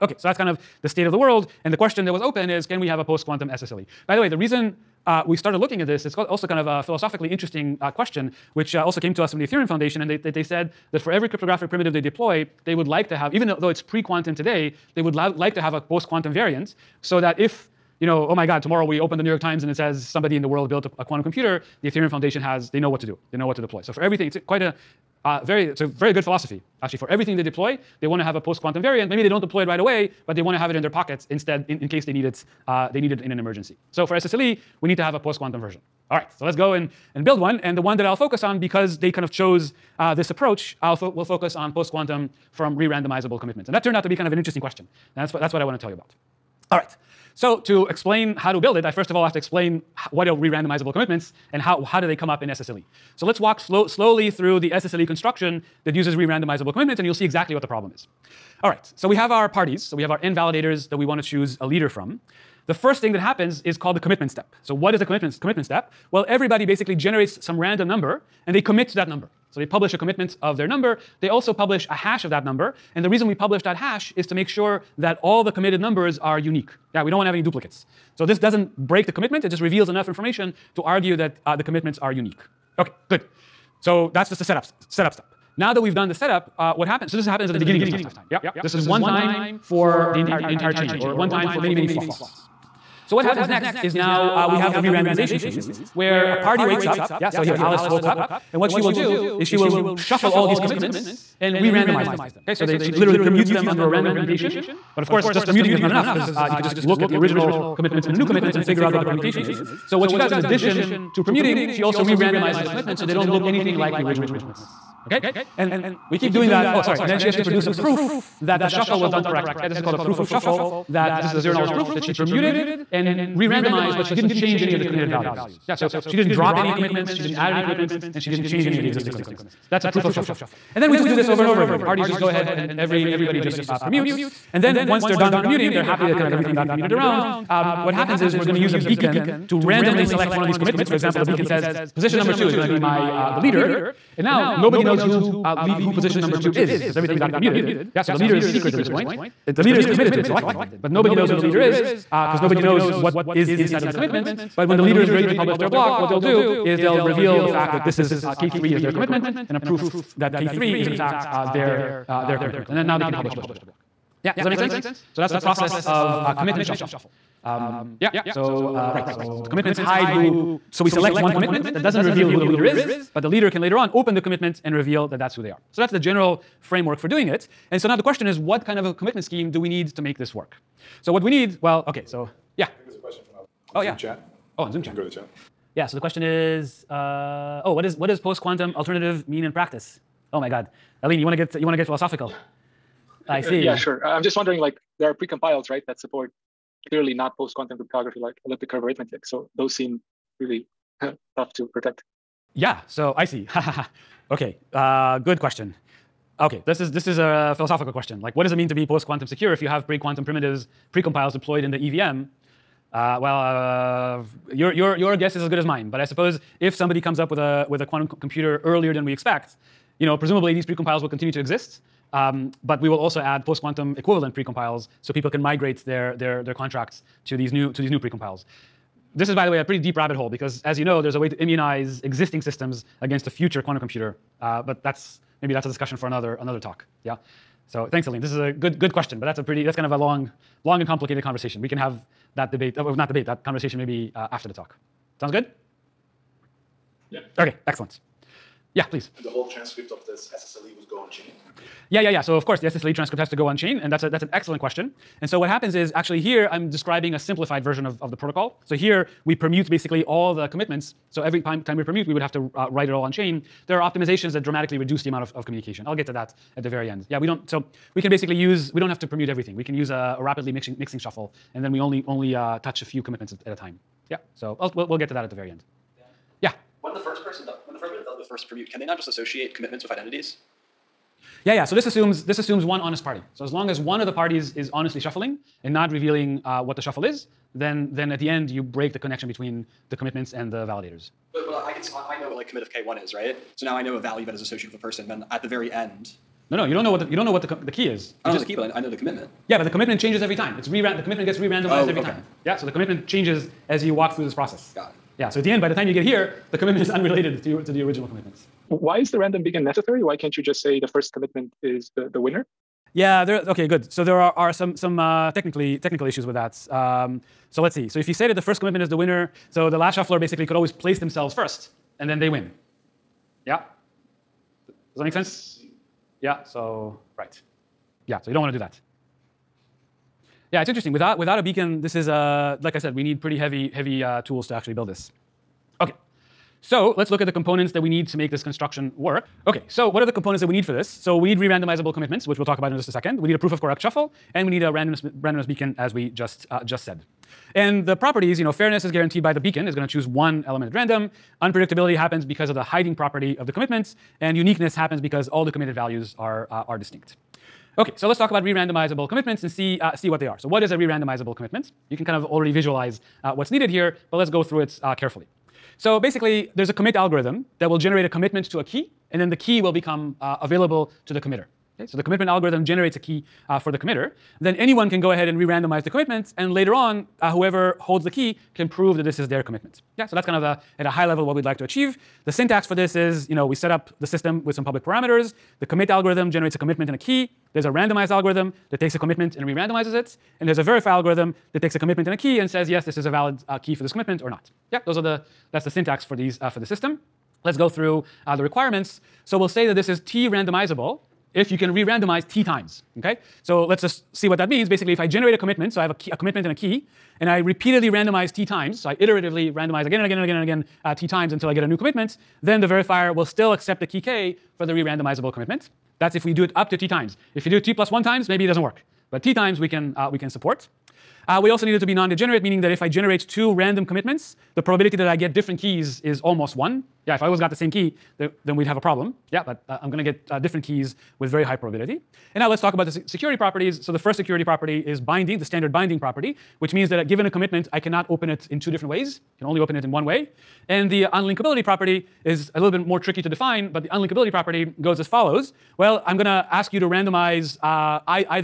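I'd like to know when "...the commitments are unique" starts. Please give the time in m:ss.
1:21.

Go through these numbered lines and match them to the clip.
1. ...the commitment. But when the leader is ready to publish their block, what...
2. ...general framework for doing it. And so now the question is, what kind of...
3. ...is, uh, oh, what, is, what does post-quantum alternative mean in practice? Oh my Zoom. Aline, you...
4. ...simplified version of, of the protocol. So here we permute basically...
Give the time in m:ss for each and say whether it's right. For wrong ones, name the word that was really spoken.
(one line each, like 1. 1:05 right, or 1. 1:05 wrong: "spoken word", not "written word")
1. 2:33 right
2. 2:55 right
3. 3:06 wrong: "God", not "Zoom"
4. 4:17 right.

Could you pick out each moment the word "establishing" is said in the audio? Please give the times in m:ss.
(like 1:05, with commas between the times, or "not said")
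not said.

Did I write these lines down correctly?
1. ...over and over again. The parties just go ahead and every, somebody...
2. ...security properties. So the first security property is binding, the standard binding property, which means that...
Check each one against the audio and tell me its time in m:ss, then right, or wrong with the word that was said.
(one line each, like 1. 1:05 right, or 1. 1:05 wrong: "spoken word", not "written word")
1. 2:11 wrong: "everybody", not "somebody"
2. 7:13 right.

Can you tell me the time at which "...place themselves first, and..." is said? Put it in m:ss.
5:20.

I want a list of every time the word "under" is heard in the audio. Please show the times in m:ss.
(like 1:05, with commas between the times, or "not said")
1:43.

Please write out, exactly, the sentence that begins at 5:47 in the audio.
And the properties, you know, fairness is guaranteed by the beacon, is going to choose one element at random.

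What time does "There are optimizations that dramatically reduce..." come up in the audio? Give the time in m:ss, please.
4:23.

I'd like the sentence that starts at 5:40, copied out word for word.
So we need re-randomizable commitments, which we'll talk about in just a second.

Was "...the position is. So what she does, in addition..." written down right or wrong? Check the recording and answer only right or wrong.
wrong.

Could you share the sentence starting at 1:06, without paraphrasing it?
Well, everybody basically generates some random number, and they commit to that number.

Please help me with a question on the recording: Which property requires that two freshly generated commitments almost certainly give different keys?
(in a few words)
Non-degenerate.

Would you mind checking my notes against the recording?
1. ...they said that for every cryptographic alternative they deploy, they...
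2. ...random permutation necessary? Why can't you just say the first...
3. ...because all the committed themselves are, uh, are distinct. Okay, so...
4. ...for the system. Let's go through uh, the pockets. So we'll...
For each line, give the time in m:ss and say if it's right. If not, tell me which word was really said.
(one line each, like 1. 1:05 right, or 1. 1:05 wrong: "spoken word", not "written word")
1. 0:10 wrong: "primitive", not "alternative"
2. 5:09 wrong: "beacon", not "permutation"
3. 5:54 wrong: "values", not "themselves"
4. 6:36 wrong: "requirements", not "pockets".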